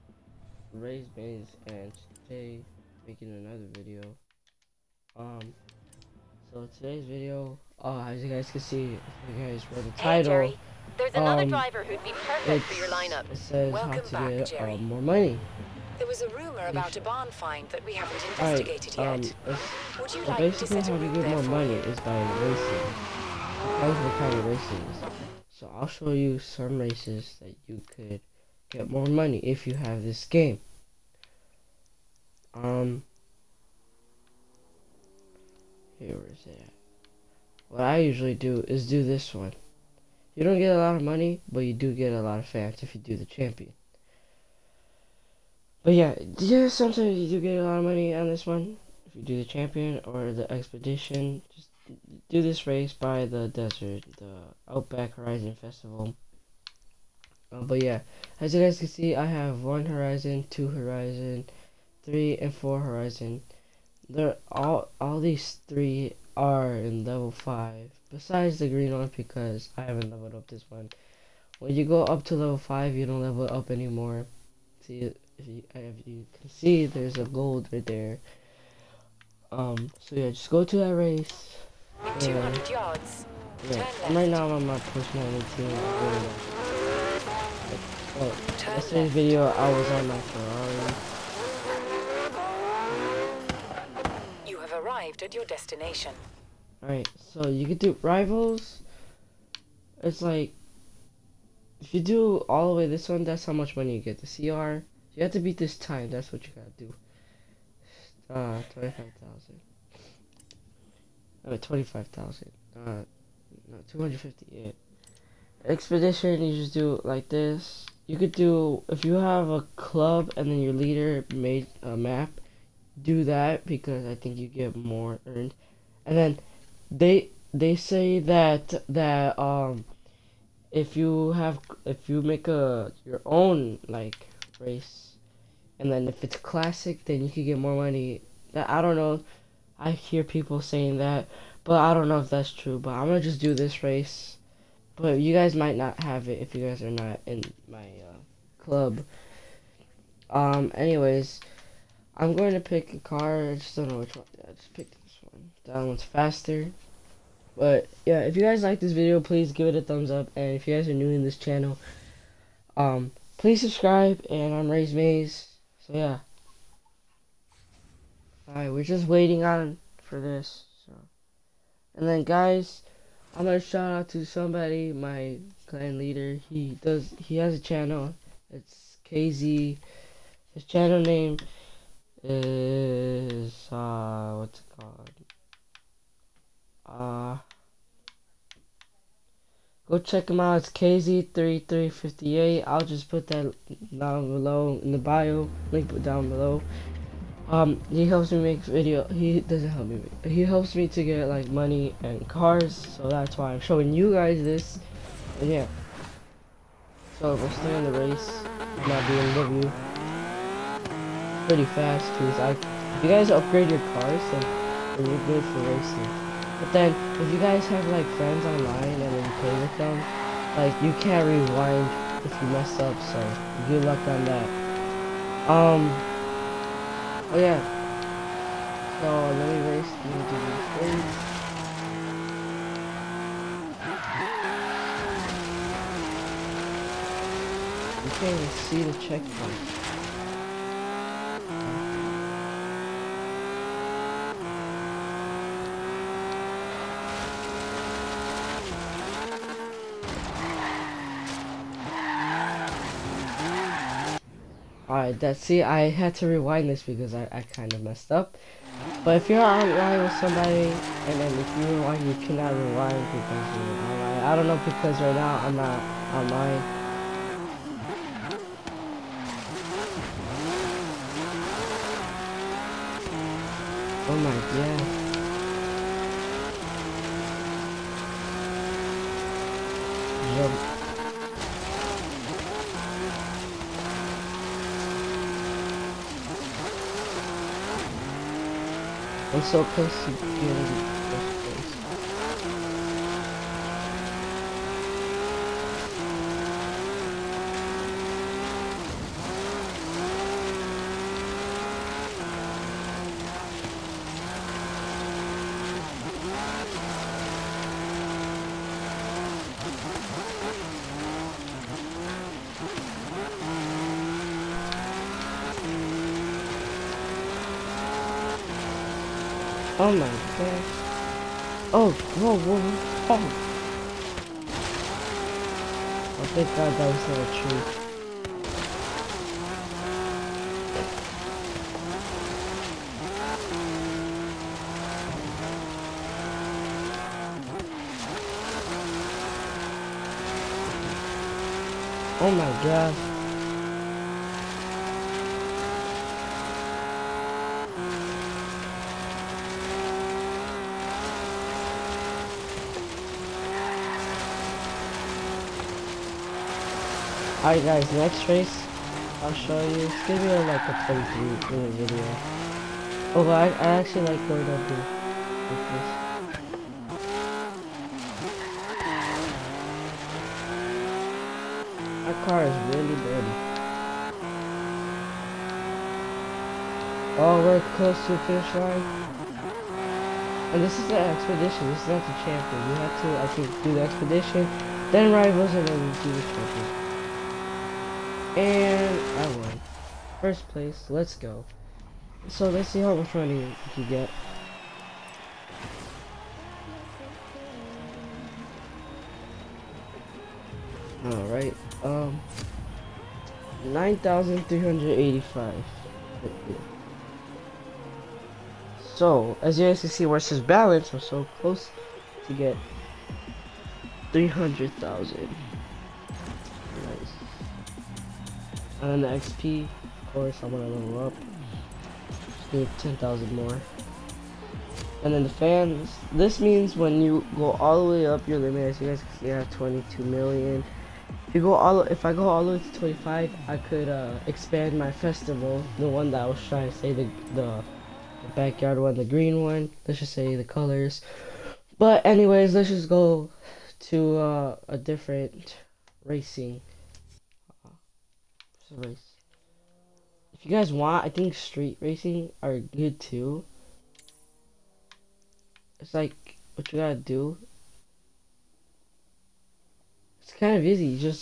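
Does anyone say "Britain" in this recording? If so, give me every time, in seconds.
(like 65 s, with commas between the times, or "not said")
not said.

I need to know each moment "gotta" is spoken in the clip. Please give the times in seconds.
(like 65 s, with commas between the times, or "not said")
106 s, 456 s.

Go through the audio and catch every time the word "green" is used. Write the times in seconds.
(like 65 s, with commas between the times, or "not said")
68 s, 439 s.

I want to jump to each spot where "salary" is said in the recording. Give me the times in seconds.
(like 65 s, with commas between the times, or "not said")
not said.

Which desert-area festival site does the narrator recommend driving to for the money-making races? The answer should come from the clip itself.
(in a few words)
Outback Horizon Festival.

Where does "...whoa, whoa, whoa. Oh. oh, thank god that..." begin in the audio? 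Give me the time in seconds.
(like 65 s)
322 s.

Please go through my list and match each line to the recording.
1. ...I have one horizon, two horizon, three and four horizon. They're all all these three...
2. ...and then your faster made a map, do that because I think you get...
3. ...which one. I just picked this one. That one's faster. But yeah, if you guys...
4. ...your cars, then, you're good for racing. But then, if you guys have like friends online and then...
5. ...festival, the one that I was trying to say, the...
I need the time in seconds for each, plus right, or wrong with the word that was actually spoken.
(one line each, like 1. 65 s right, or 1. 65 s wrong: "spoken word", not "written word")
1. 59 s right
2. 120 s wrong: "leader", not "faster"
3. 153 s right
4. 213 s right
5. 434 s right.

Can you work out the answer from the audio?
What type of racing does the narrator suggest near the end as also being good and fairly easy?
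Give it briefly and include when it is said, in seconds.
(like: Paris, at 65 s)
street racing, at 451 s.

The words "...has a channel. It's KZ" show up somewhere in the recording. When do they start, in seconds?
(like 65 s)
177 s.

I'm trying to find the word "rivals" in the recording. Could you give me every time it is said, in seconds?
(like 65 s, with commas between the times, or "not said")
98 s, 385 s.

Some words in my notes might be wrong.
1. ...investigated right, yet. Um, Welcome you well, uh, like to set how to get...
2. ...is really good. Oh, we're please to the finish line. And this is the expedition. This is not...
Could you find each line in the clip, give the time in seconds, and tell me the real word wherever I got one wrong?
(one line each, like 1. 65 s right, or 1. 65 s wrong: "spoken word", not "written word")
1. 18 s wrong: "Would", not "Welcome"
2. 372 s wrong: "close", not "please".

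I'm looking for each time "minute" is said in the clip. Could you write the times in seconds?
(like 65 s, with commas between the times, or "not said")
361 s.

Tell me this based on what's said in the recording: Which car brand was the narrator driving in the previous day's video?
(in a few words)
Ferrari.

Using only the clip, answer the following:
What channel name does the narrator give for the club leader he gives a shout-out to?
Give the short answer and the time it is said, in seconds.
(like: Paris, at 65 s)
KZ3358, at 190 s.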